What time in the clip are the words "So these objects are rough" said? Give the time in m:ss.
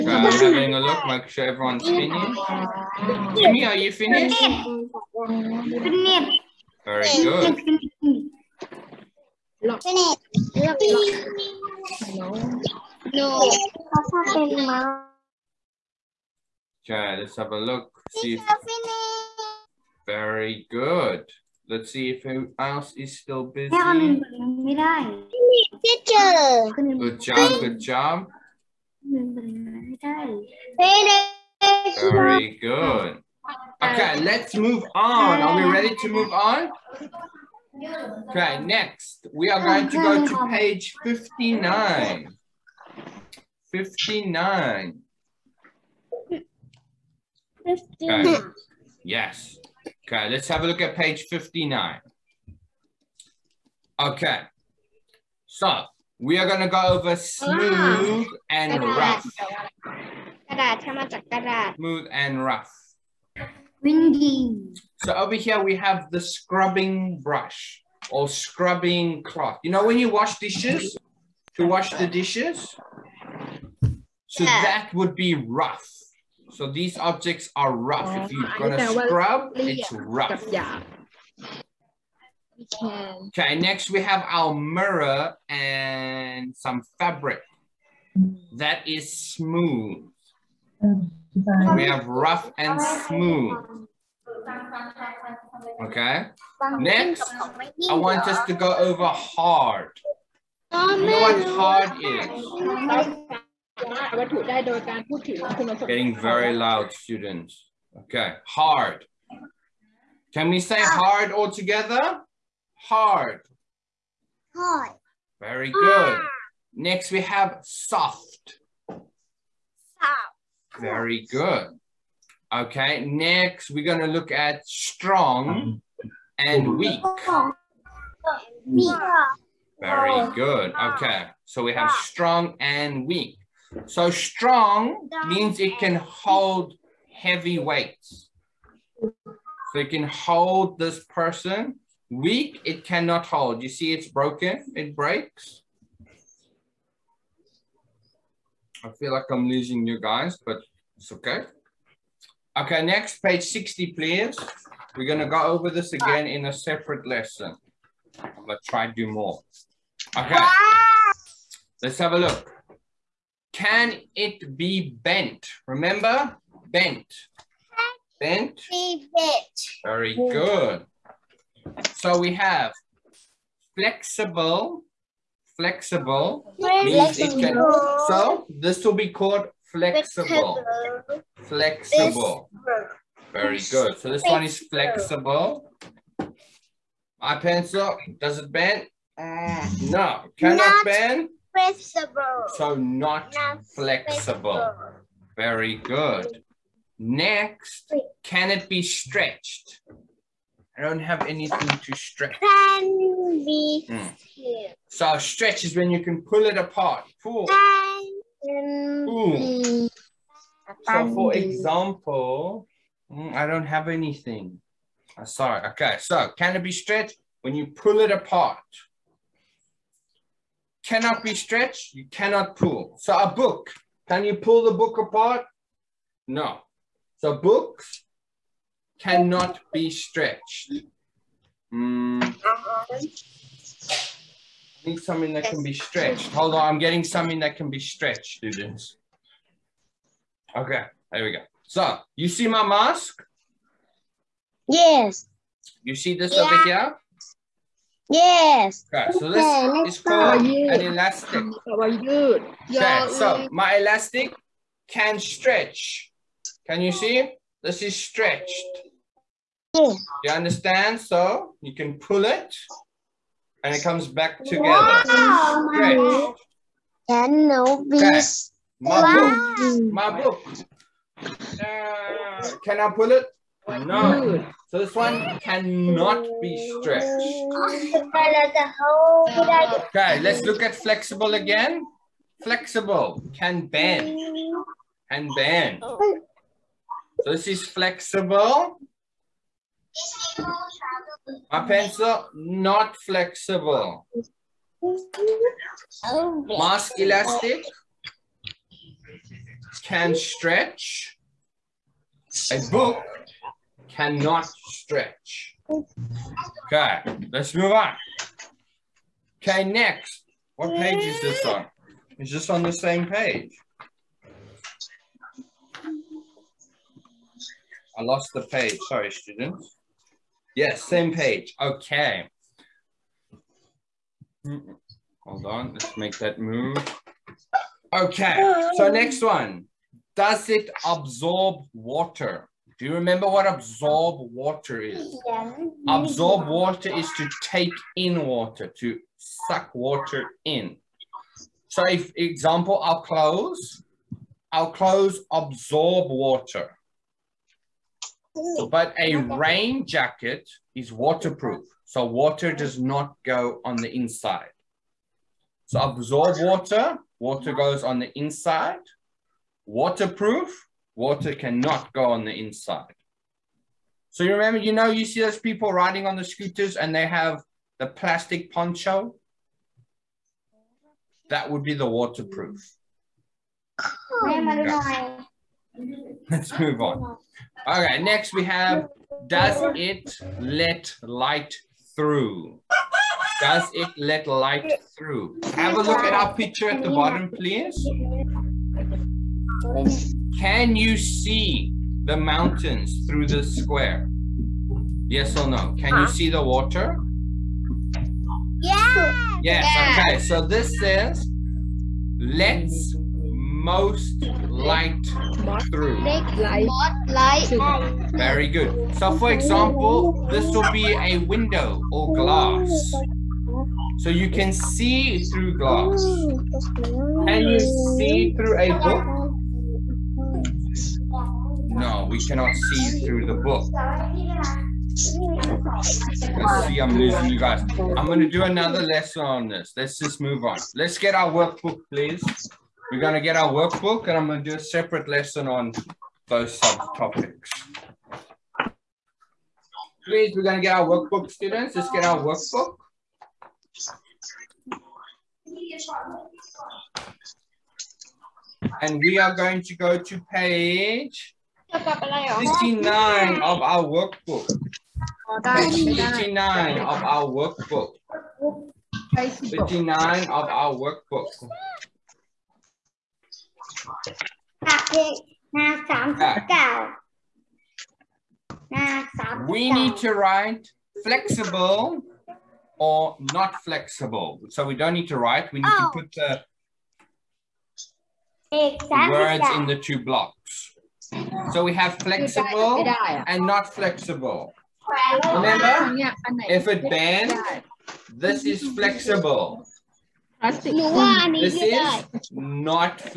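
1:16.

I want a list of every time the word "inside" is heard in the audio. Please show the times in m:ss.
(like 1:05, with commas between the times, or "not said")
5:53, 5:58, 6:02.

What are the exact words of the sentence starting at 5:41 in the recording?
So if example, our clothes, our clothes absorb water.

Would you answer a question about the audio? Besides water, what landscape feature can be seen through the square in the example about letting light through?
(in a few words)
mountains.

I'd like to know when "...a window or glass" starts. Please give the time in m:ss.
6:51.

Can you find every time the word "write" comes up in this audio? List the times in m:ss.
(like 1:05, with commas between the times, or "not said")
7:50, 7:55.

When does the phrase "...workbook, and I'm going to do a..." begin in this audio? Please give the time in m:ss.
7:13.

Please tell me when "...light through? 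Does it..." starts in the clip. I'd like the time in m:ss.
6:21.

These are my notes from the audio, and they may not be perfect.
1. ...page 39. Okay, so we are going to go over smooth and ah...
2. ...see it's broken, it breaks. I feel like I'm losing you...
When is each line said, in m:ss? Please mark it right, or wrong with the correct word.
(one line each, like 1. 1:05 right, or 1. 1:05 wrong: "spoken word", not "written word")
1. 0:50 wrong: "59", not "39"
2. 2:23 right.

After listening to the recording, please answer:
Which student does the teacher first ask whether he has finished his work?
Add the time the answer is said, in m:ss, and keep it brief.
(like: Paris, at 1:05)
Jimmy, at 0:03.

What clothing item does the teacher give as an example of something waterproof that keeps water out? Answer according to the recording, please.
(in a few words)
rain jacket.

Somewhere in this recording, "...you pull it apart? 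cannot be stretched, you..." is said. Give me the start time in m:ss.
3:37.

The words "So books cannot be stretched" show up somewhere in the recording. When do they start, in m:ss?
3:47.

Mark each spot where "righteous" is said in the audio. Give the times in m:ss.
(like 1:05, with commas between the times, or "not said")
not said.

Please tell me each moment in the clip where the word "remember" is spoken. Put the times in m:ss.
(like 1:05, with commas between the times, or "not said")
2:45, 5:32, 6:04, 8:05.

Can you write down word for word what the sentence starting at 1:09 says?
You know when you wash dishes, to wash the dishes?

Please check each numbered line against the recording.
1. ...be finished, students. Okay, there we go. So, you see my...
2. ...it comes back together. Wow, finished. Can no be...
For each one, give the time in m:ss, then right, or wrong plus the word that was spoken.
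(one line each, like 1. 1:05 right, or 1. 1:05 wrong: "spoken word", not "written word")
1. 3:57 wrong: "stretched", not "finished"
2. 4:23 wrong: "stretched", not "finished".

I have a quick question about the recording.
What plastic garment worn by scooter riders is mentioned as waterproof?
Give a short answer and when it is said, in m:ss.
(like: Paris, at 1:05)
plastic poncho, at 6:07.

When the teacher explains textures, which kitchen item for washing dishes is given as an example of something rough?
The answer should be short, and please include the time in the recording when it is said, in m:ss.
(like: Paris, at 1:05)
scrubbing brush, at 1:06.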